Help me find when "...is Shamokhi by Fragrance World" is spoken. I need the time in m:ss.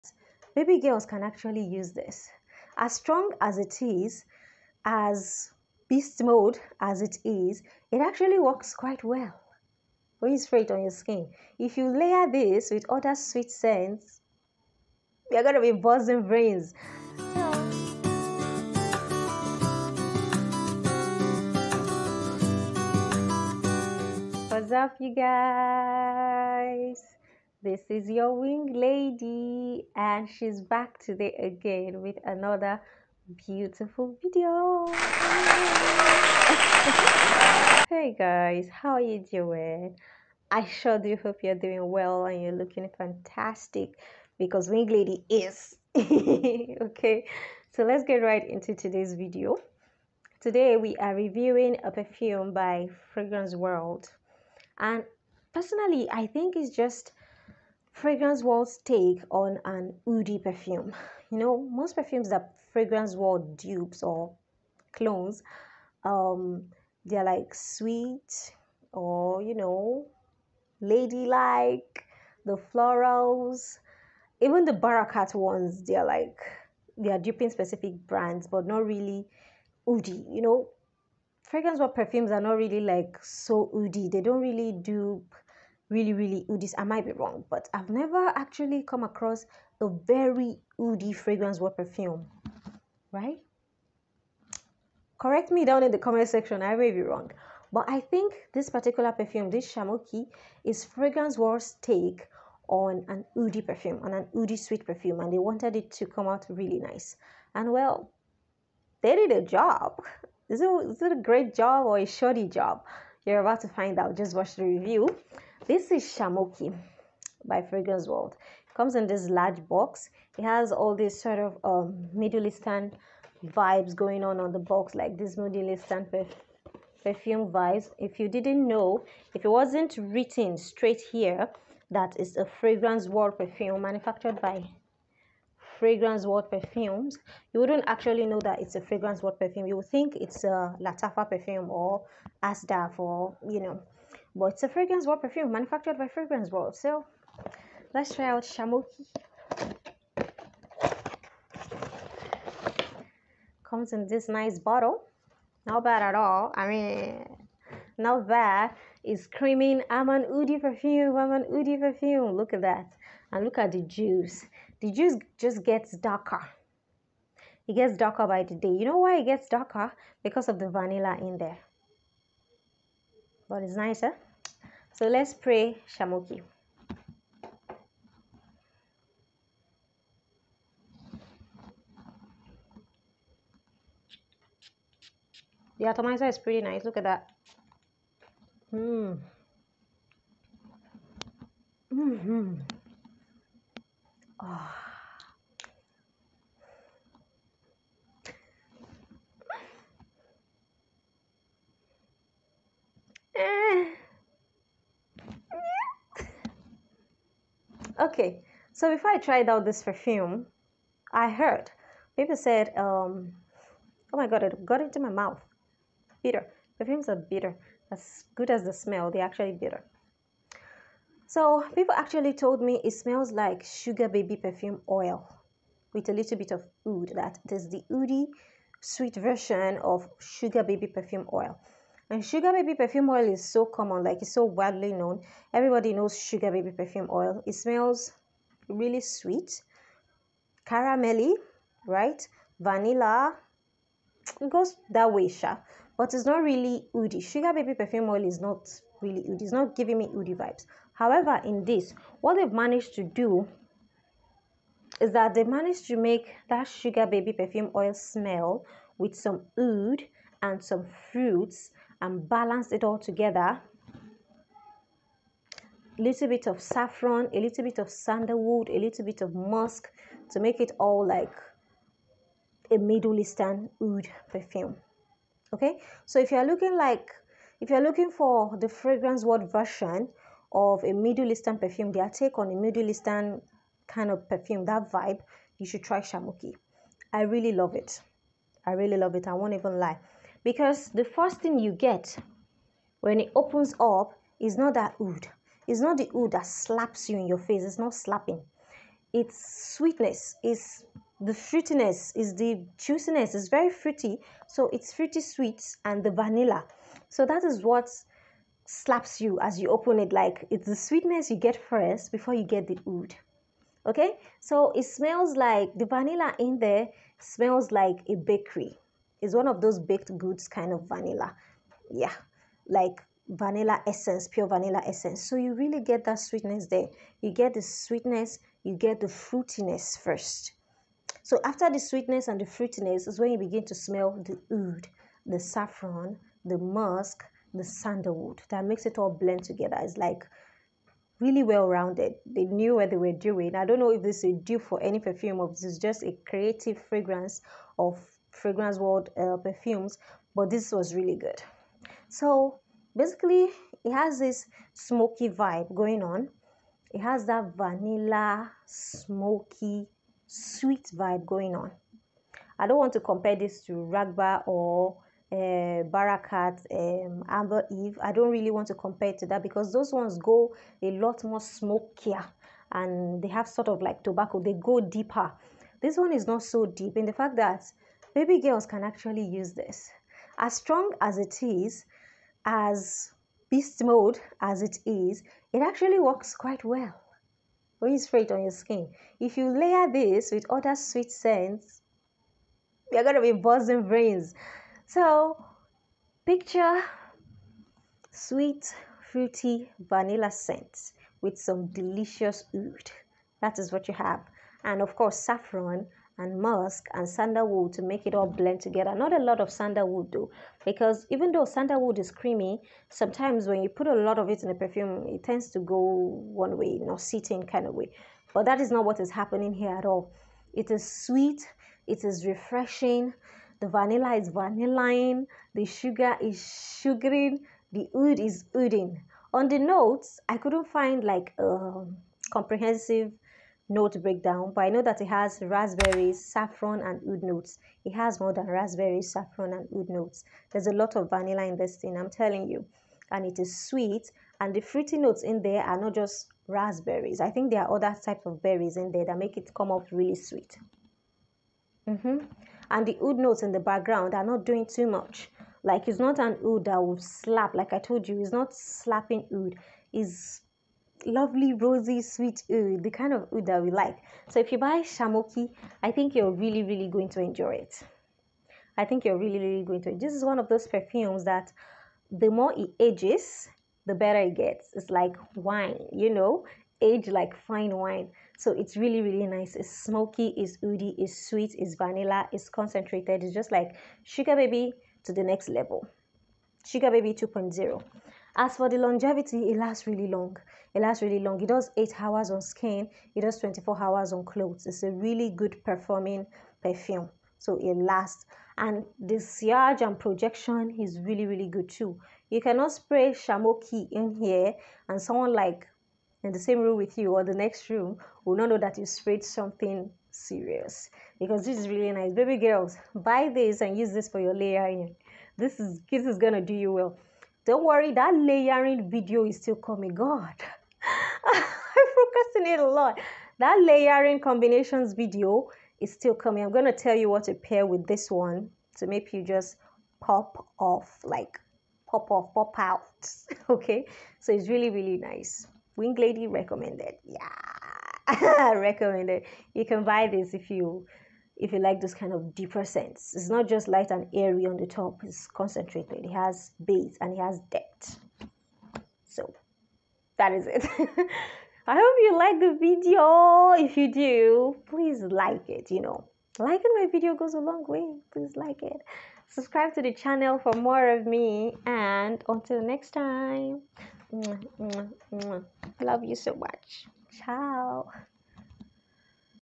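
1:55.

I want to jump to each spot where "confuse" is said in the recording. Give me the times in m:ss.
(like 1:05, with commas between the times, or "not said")
not said.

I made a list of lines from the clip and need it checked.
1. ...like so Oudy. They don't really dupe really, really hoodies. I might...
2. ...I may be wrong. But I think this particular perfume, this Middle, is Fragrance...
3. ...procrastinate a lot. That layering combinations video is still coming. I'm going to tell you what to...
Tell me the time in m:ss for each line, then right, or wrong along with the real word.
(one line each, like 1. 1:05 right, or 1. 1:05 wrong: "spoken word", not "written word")
1. 1:22 right
2. 1:36 wrong: "Shamokhi", not "Middle"
3. 8:42 right.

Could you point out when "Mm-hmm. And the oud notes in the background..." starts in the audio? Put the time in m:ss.
7:31.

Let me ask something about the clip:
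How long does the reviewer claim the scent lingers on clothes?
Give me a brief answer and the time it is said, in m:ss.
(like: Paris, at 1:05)
24 hours, at 8:13.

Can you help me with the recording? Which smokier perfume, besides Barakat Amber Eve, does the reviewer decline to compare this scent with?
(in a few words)
Raghba.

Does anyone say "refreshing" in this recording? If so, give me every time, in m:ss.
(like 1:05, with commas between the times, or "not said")
7:02.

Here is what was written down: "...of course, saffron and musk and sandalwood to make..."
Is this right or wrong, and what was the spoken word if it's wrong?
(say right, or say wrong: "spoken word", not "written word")
right.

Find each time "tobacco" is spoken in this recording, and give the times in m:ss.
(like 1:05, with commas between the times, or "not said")
6:14.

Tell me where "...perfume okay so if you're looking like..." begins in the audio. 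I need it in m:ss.
4:34.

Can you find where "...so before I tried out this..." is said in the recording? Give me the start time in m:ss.
3:28.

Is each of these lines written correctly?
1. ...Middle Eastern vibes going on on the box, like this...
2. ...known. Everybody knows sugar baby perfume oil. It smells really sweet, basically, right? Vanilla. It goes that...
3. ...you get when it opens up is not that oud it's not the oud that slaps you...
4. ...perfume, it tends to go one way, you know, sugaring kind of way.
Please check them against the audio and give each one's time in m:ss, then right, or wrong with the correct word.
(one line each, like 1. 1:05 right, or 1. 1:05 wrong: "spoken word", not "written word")
1. 2:02 right
2. 3:54 wrong: "caramelly", not "basically"
3. 4:51 right
4. 6:54 wrong: "sitting", not "sugaring".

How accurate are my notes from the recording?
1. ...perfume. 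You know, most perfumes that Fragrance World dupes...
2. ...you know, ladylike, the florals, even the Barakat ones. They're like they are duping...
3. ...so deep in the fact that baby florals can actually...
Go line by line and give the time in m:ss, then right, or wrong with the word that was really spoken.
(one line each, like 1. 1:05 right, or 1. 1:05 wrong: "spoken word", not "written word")
1. 1:00 right
2. 1:09 right
3. 6:16 wrong: "girls", not "florals".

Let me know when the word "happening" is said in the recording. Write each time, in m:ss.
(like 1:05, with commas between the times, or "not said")
6:59.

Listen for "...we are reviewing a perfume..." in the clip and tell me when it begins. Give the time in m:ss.
0:50.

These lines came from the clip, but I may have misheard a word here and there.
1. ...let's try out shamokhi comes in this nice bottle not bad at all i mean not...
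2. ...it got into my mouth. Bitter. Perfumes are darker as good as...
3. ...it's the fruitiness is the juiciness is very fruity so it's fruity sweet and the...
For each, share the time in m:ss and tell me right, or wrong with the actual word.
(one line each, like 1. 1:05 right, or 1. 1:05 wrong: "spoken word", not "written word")
1. 2:27 right
2. 3:34 wrong: "bitter", not "darker"
3. 5:00 right.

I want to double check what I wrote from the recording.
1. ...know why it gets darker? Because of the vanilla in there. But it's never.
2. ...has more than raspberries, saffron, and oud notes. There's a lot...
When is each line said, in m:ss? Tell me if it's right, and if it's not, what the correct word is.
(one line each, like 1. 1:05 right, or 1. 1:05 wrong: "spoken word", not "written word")
1. 2:48 wrong: "nicer", not "never"
2. 7:17 right.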